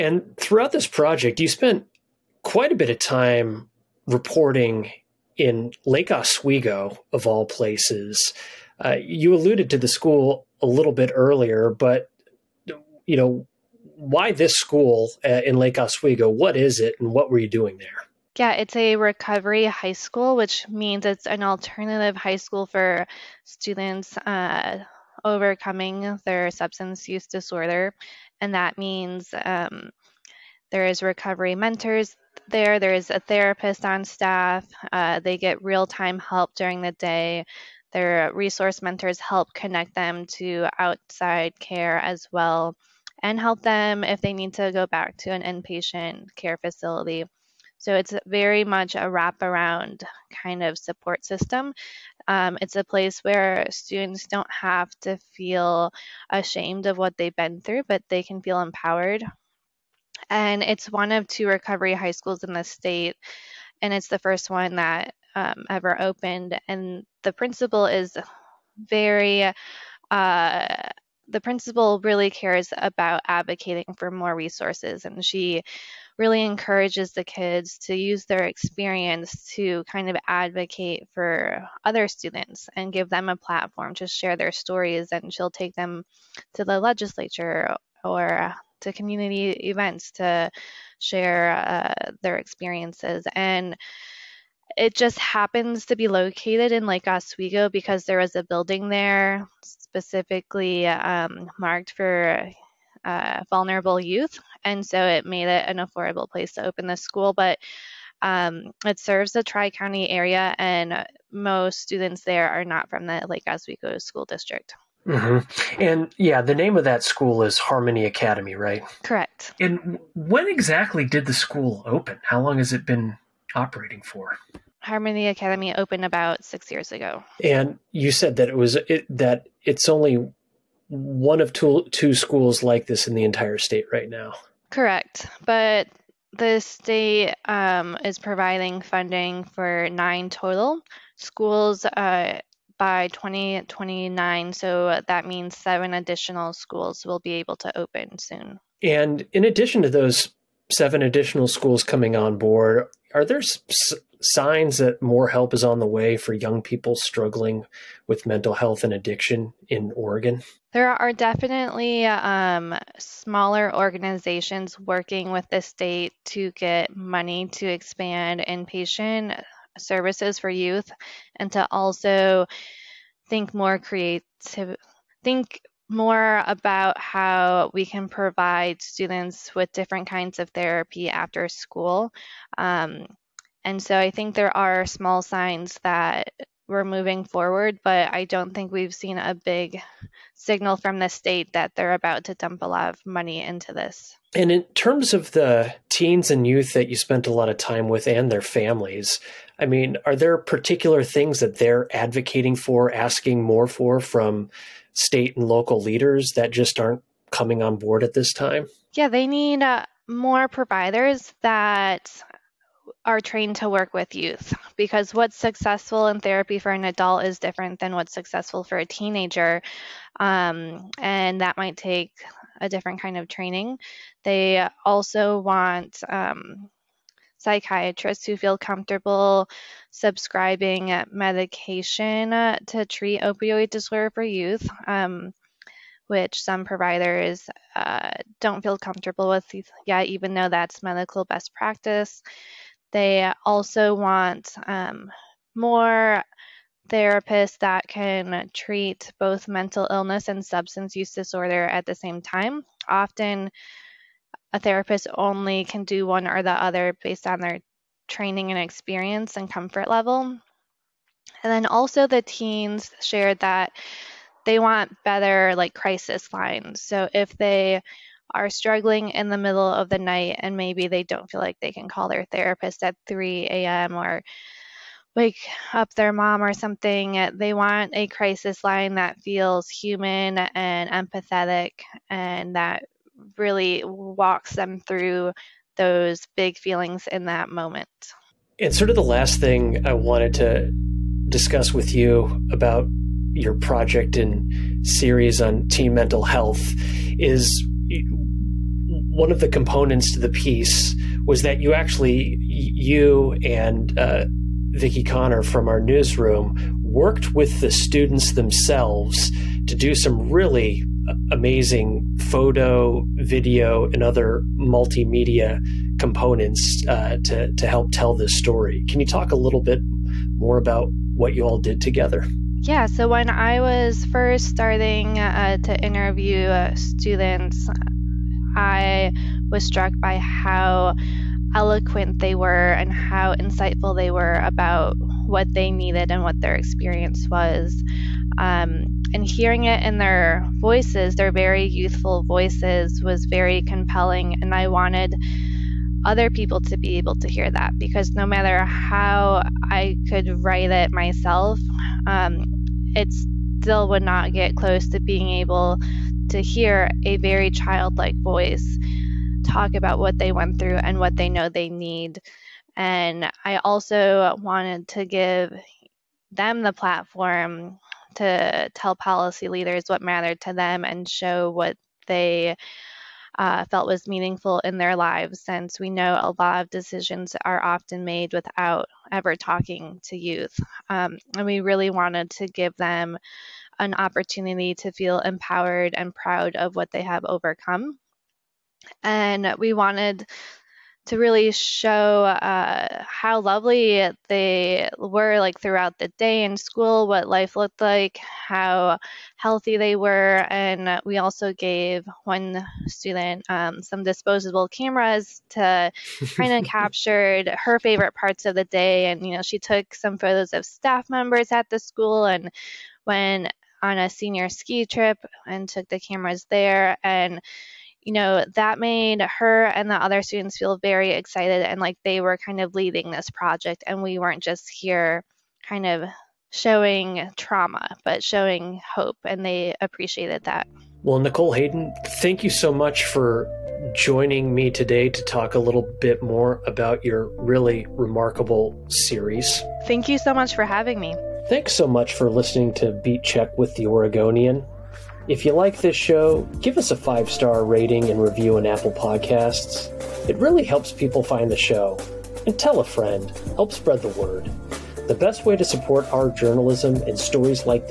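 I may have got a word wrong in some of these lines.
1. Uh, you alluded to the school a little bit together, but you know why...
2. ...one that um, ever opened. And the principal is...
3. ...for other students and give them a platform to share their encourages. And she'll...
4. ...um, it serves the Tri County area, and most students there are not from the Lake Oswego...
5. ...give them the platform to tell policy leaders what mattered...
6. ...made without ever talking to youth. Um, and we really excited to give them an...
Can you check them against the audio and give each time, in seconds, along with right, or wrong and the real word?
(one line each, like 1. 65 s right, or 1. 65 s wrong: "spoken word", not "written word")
1. 8 s wrong: "earlier", not "together"
2. 64 s right
3. 81 s wrong: "stories", not "encourages"
4. 108 s right
5. 365 s right
6. 378 s wrong: "wanted", not "excited".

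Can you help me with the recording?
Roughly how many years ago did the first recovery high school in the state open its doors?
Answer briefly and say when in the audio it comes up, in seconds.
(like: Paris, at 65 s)
6, at 126 s.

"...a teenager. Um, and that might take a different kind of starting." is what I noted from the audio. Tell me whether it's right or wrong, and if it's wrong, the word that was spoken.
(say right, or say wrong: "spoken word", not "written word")
wrong: "training", not "starting".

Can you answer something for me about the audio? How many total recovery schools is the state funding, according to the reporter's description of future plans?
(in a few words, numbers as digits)
9.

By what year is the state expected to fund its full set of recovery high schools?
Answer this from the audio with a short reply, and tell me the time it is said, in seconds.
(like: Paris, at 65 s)
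2029, at 143 s.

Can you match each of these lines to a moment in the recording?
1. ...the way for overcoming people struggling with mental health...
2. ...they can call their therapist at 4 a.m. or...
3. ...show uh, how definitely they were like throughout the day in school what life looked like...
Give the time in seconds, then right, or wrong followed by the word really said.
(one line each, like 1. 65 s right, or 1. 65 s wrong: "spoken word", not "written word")
1. 155 s wrong: "young", not "overcoming"
2. 271 s wrong: "3", not "4"
3. 391 s wrong: "lovely", not "definitely".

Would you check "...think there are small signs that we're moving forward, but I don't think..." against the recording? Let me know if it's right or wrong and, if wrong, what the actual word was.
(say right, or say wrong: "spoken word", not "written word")
right.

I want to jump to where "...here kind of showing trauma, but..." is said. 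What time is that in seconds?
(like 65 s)
424 s.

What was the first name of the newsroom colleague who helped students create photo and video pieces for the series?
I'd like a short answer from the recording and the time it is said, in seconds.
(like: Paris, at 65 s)
Connor, at 305 s.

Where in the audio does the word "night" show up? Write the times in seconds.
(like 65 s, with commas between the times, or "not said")
269 s.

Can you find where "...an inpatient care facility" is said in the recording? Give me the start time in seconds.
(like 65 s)
45 s.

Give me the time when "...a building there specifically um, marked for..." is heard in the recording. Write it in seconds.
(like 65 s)
98 s.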